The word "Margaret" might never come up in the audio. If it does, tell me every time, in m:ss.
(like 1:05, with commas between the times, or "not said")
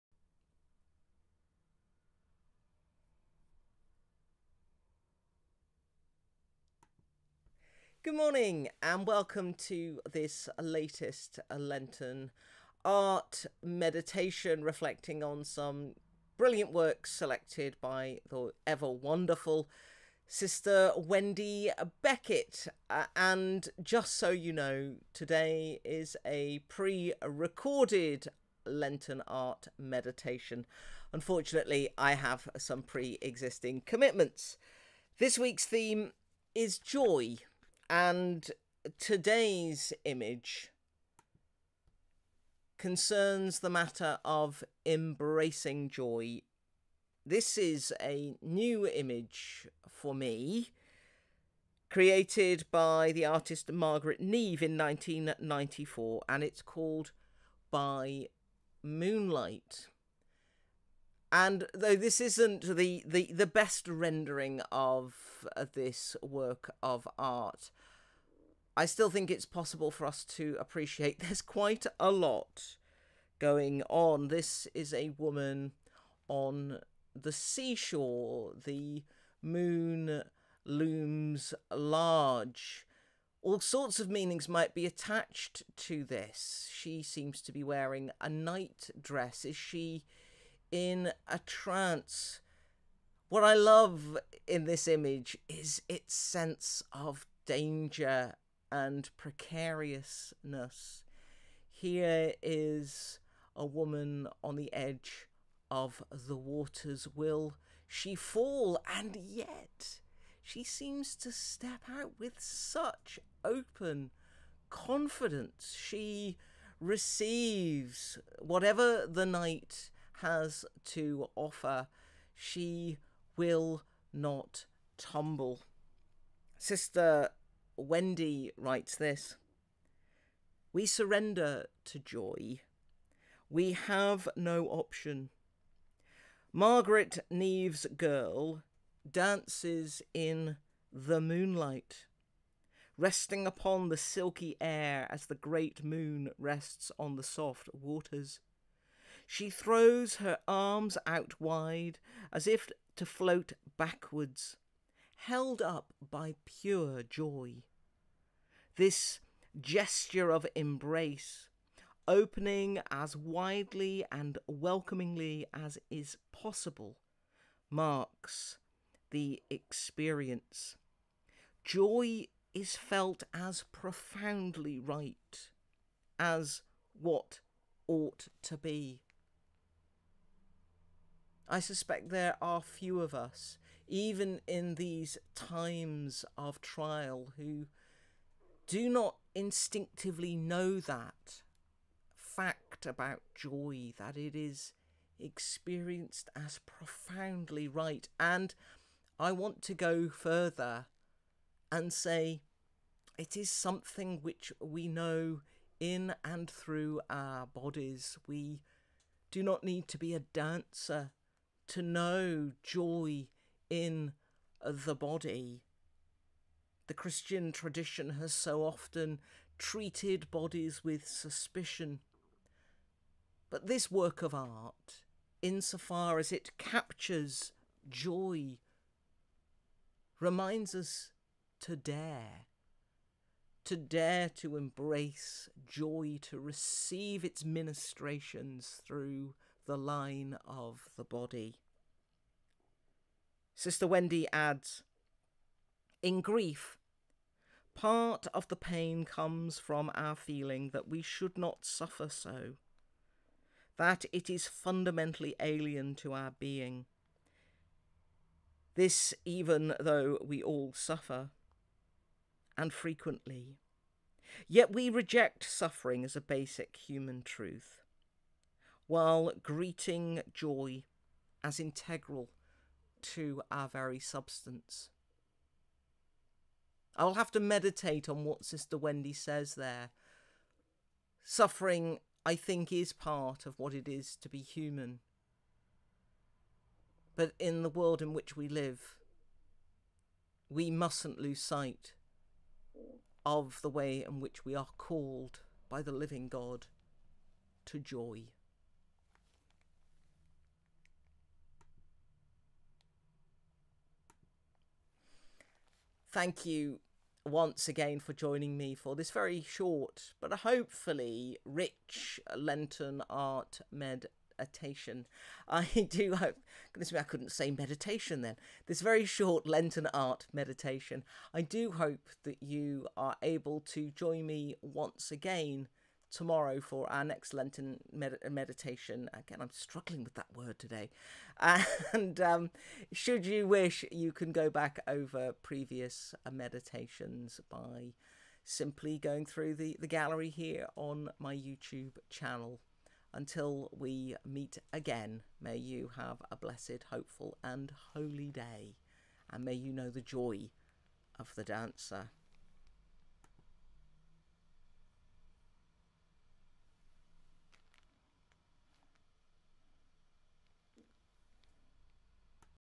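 0:53, 2:16.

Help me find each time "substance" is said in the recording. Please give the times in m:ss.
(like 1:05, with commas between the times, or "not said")
4:33.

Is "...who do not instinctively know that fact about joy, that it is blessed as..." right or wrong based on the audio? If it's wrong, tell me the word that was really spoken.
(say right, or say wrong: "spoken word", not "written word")
wrong: "experienced", not "blessed".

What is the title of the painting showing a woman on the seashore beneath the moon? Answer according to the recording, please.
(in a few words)
By Moonlight.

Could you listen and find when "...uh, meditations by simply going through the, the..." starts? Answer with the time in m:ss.
5:36.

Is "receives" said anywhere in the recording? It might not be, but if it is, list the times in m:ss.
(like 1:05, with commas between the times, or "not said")
1:56, 3:56.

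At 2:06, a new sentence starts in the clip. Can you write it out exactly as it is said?
Sister Wendy writes this We surrender to joy.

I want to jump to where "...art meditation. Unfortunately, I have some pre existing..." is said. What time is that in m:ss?
0:29.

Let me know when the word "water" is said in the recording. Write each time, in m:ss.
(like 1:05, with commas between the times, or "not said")
1:46, 2:27.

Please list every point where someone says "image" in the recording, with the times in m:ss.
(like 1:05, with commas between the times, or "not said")
0:40, 0:48, 1:34.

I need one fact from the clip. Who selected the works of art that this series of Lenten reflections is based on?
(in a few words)
Sister Wendy Beckett.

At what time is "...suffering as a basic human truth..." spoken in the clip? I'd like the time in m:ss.
4:25.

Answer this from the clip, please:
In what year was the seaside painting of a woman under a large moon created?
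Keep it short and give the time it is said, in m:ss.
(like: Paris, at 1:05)
1994, at 0:54.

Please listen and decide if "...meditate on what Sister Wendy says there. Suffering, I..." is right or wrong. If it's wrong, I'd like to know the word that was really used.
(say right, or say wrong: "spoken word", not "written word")
right.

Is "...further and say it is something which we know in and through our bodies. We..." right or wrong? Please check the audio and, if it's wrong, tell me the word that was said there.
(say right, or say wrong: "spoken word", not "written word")
right.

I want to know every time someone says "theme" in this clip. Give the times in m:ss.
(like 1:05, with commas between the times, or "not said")
0:35.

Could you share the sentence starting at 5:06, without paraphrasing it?
thank you once again for joining me for this very short but hopefully rich Lenten art meditation.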